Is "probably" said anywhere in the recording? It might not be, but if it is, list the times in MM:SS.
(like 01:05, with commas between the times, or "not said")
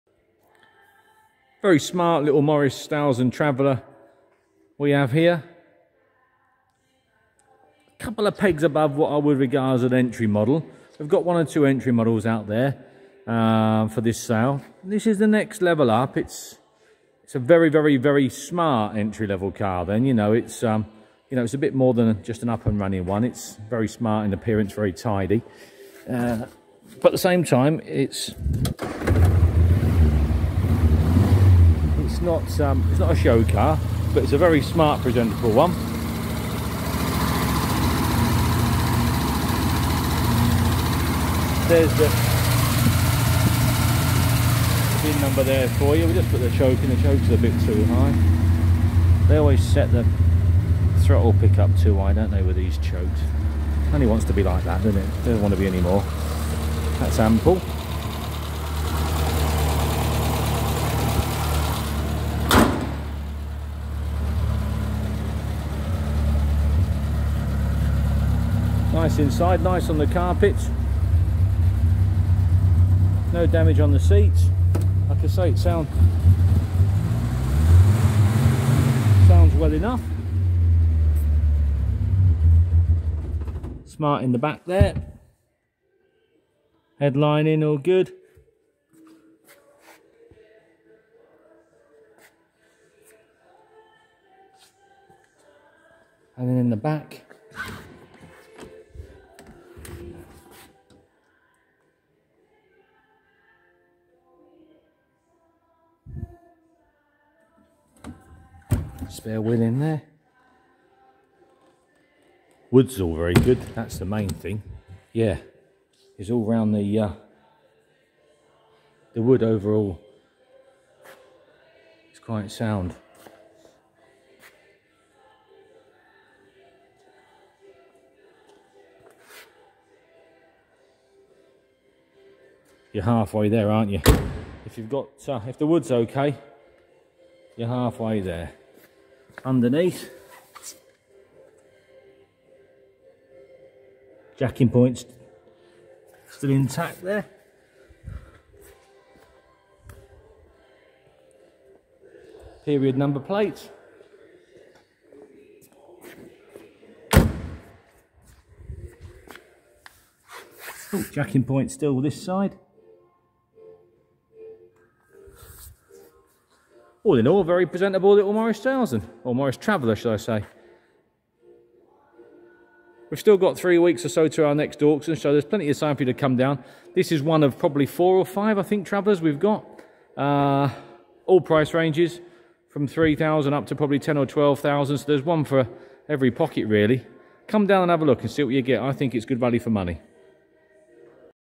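02:57, 03:03.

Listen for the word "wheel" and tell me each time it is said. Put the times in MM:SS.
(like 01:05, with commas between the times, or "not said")
01:49.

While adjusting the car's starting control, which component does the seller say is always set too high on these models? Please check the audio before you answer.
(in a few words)
Throttle pickup.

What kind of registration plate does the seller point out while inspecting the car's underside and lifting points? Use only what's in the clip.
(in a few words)
Period number plate.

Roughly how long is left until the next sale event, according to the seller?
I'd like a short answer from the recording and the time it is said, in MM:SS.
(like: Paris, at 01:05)
3 weeks, at 02:53.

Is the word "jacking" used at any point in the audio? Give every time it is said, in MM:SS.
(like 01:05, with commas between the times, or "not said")
02:24, 02:41.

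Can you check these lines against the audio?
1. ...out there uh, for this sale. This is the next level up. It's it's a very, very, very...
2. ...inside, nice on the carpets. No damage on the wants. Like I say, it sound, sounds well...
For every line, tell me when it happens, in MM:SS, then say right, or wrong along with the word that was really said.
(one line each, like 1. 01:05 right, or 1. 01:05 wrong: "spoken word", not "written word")
1. 00:12 right
2. 01:09 wrong: "seats", not "wants".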